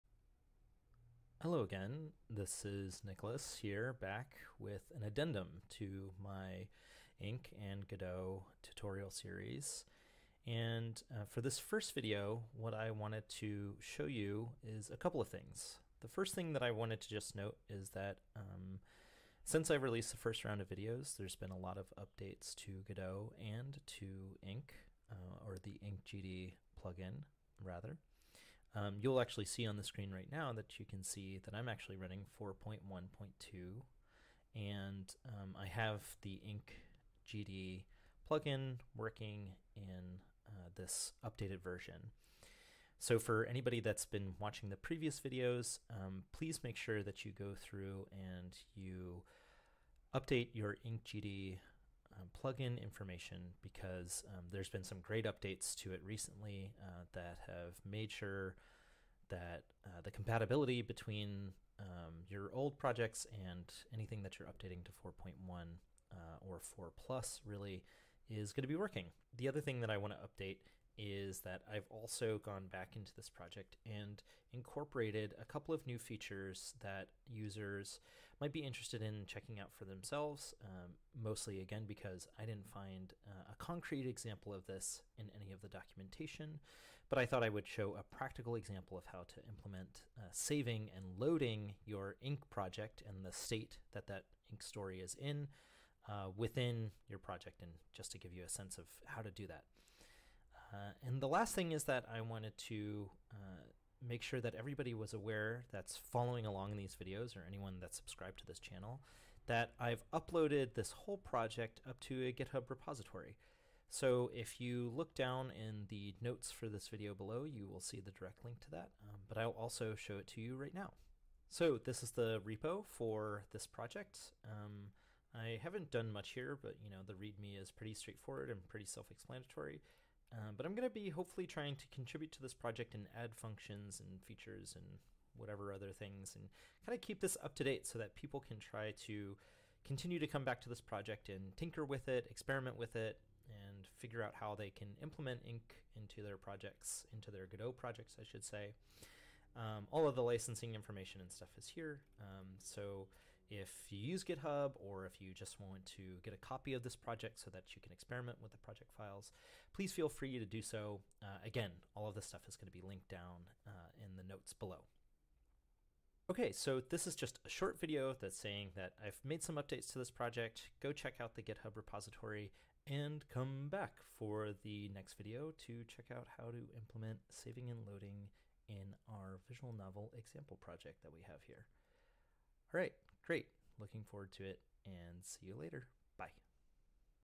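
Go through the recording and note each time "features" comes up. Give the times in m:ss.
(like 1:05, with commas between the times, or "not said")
1:15, 2:14.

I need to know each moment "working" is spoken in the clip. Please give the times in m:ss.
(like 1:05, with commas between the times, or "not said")
0:38, 1:08.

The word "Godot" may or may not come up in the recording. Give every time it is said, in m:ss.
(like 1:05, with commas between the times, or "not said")
0:07, 0:22, 2:27.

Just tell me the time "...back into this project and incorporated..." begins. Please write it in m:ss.
1:12.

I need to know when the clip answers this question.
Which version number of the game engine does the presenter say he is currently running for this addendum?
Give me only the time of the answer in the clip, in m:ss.
0:32.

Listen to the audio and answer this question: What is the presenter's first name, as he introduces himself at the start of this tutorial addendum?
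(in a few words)
Nicholas.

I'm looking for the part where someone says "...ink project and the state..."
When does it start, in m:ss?
1:32.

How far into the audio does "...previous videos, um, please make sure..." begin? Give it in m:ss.
0:44.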